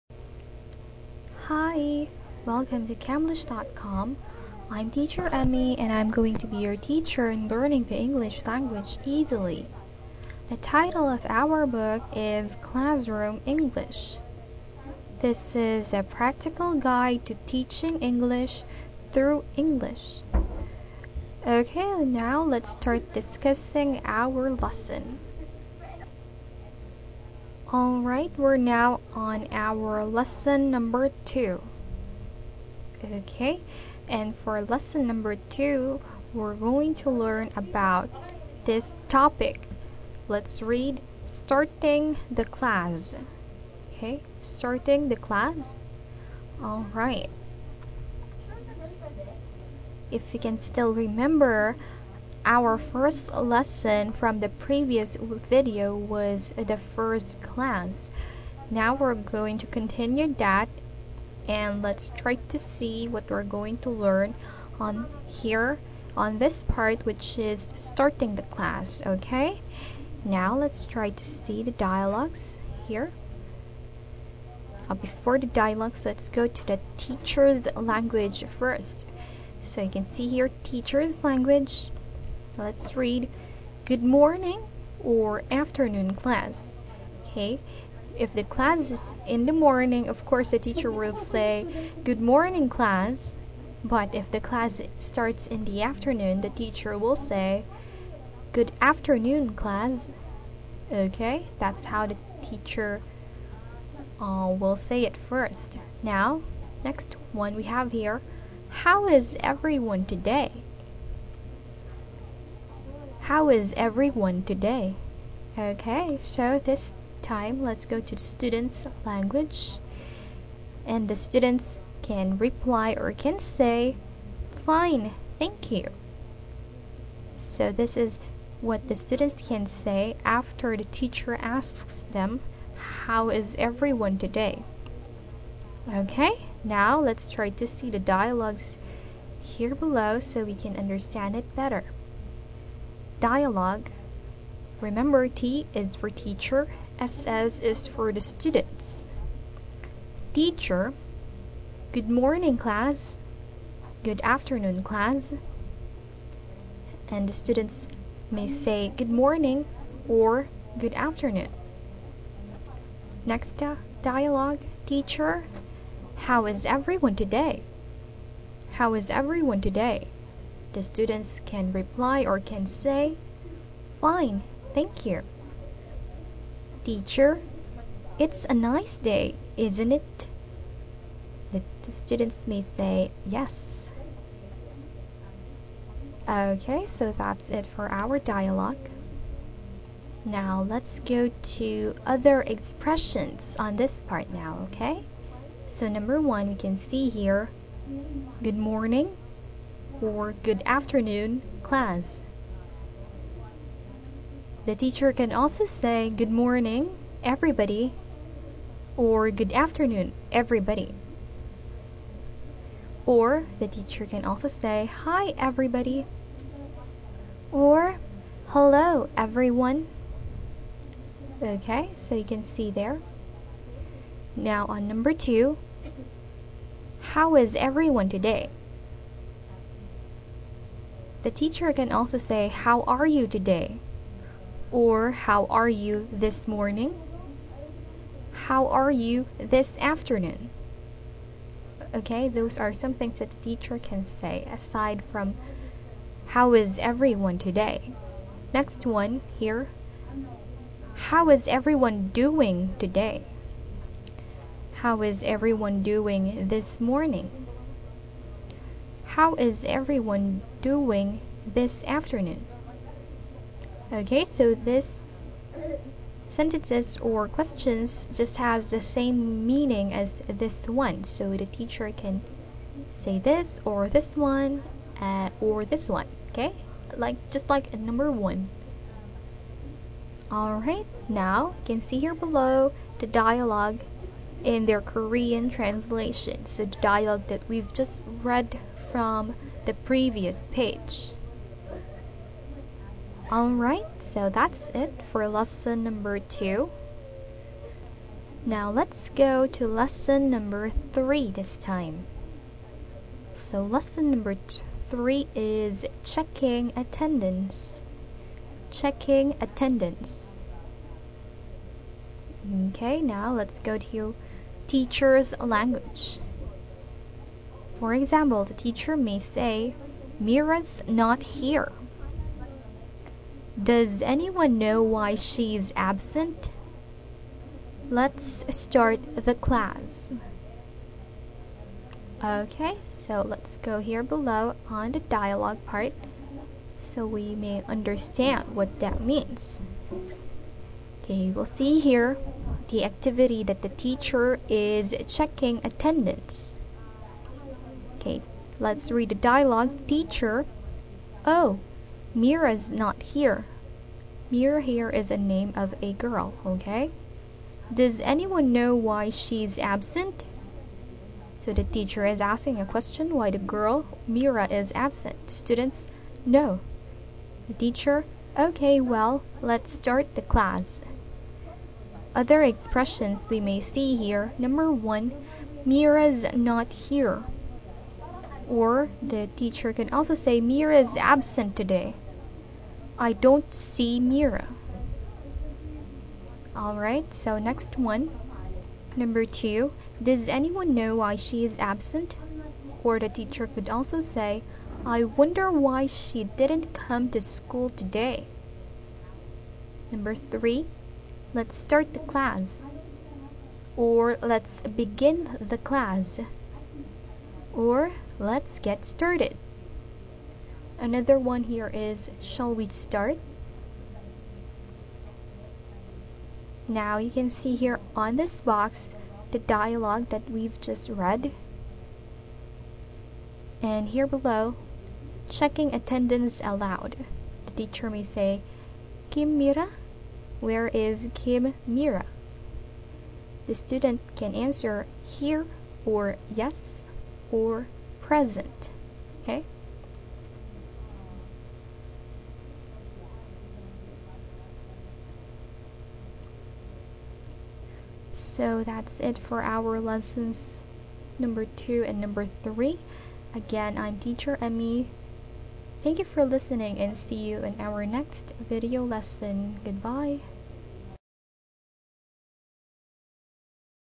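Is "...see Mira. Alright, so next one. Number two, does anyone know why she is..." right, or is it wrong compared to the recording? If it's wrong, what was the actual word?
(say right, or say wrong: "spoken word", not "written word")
right.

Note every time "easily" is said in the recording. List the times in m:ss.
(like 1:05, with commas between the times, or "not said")
0:09.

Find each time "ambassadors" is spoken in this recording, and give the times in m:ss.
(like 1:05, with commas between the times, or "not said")
not said.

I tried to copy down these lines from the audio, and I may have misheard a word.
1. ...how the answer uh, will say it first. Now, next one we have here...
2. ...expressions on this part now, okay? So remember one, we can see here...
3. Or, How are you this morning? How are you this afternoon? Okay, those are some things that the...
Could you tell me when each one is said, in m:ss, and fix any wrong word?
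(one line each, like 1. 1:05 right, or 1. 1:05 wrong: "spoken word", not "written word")
1. 1:41 wrong: "teacher", not "answer"
2. 3:12 wrong: "number", not "remember"
3. 3:54 right.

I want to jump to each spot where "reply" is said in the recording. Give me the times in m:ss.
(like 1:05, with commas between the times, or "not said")
2:02, 2:51.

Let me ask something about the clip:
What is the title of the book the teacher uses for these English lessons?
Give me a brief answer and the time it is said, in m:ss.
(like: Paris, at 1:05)
Classroom English, at 0:12.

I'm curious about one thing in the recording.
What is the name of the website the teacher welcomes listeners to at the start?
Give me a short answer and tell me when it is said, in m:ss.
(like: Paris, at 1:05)
Camlish.com, at 0:02.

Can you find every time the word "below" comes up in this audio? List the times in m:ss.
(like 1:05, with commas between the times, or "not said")
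2:19, 4:42, 5:34, 7:04.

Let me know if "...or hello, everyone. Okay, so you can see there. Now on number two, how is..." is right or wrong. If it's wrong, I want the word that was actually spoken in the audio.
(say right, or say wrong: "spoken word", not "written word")
right.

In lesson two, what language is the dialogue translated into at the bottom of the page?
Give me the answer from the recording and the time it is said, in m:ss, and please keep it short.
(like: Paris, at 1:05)
Korean, at 4:44.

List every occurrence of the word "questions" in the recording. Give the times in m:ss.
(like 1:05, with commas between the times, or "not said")
4:27, 6:02.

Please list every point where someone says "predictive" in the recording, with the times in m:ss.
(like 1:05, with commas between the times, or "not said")
not said.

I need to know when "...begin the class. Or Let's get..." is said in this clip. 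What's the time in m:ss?
6:44.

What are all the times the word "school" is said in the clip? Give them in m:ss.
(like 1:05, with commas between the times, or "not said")
6:37.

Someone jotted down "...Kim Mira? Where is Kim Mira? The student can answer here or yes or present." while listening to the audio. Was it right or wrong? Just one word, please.
right.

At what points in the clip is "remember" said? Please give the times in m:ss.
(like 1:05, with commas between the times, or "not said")
0:50, 2:24.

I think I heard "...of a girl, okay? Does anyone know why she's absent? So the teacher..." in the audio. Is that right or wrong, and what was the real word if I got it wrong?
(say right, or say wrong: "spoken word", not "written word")
right.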